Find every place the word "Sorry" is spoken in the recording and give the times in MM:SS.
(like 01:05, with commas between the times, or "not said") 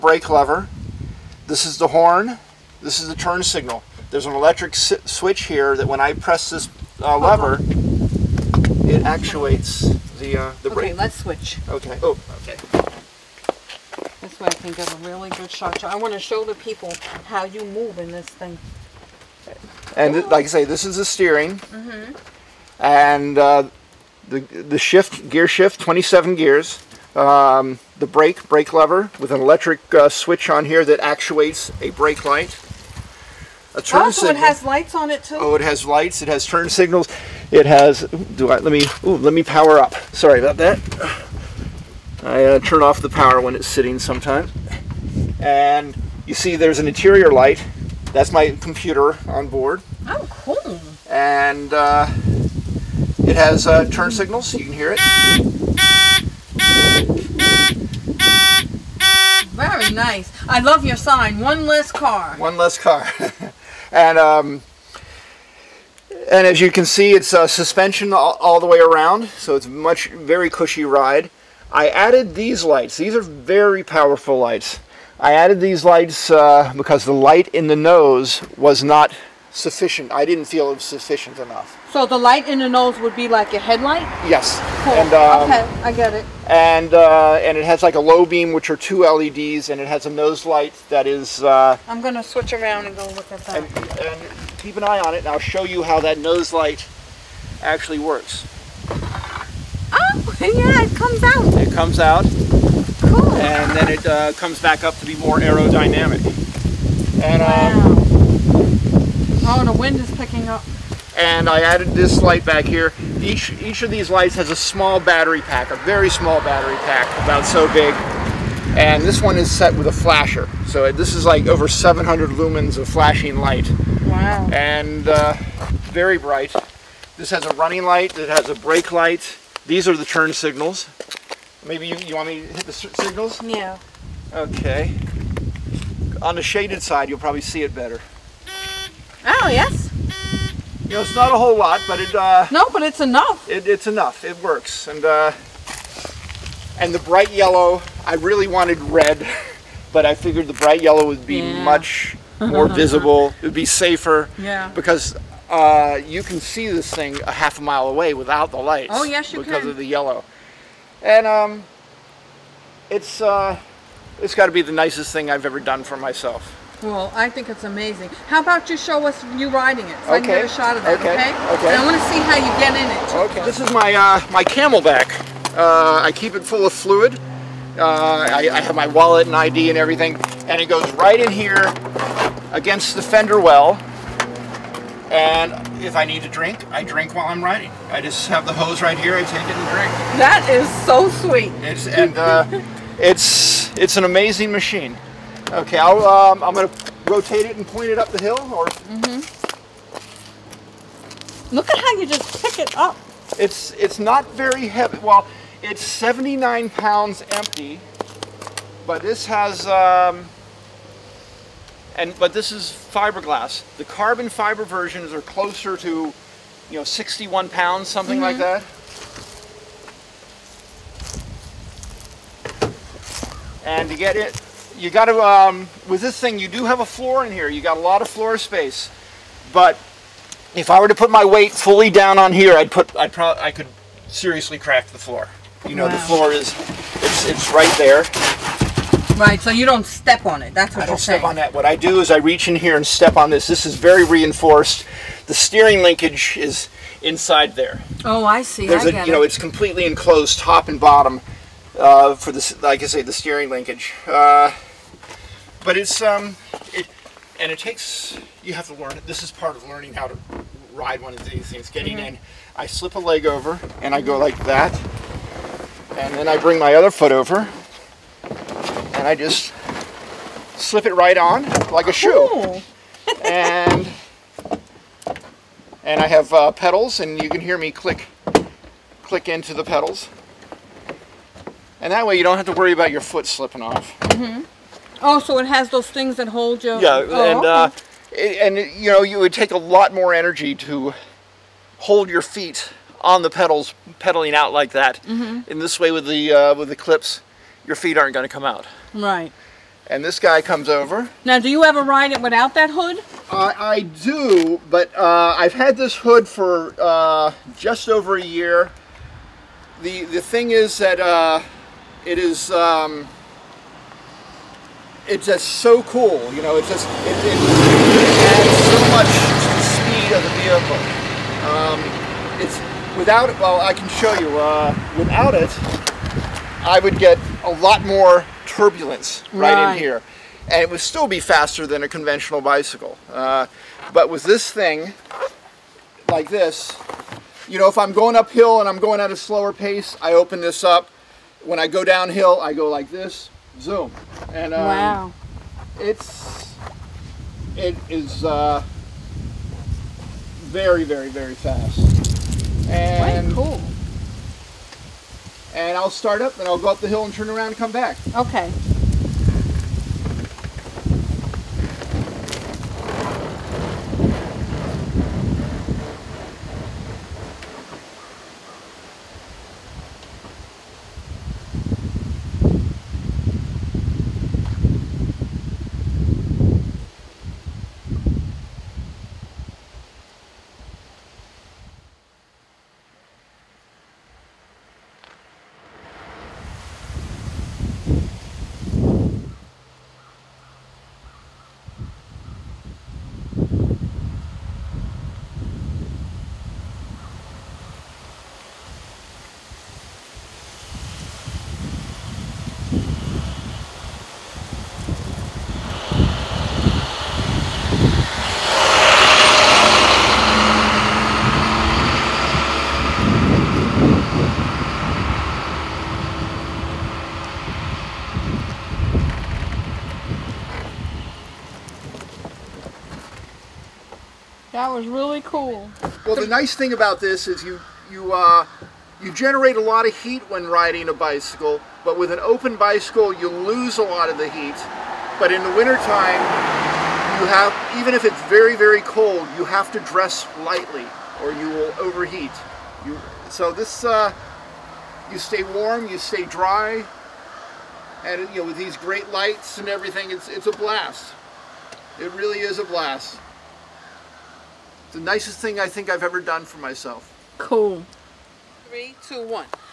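00:40.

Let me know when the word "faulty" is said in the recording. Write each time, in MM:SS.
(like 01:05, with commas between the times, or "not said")
not said.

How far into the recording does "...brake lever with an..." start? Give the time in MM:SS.
00:28.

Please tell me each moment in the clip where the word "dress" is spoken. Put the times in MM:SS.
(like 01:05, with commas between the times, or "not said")
07:19.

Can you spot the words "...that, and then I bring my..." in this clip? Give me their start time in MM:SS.
04:24.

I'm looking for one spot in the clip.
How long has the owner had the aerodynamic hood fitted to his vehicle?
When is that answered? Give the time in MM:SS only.
05:07.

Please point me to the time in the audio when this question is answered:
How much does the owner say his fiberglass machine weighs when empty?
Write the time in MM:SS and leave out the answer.
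03:25.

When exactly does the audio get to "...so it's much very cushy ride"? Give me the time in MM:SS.
01:09.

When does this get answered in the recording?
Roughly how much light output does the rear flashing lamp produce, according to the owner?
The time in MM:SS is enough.
02:01.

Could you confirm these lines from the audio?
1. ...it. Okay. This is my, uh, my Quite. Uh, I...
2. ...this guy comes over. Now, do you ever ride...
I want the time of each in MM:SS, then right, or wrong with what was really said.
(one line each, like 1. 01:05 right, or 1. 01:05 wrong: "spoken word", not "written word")
1. 02:52 wrong: "CamelBak", not "Quite"
2. 05:00 right.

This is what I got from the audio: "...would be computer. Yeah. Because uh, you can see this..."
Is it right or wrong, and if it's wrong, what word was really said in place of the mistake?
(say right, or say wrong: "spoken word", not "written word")
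wrong: "safer", not "computer".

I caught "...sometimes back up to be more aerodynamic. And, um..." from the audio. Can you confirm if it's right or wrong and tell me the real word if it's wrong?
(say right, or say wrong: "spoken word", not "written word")
wrong: "comes", not "sometimes".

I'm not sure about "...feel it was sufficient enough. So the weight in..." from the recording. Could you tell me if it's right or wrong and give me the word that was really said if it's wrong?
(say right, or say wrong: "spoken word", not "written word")
wrong: "light", not "weight".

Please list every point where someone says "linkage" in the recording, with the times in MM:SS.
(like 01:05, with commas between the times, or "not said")
04:05, 04:13.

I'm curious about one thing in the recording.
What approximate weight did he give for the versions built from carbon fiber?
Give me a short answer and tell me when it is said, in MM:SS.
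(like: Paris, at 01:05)
61 pounds, at 03:36.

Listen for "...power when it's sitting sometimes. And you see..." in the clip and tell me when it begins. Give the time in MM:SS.
00:43.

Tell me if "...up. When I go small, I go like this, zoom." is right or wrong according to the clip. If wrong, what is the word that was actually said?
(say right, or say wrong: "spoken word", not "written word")
wrong: "downhill", not "small".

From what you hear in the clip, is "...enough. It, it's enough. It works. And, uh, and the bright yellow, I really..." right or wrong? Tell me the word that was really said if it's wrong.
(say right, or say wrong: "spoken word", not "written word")
right.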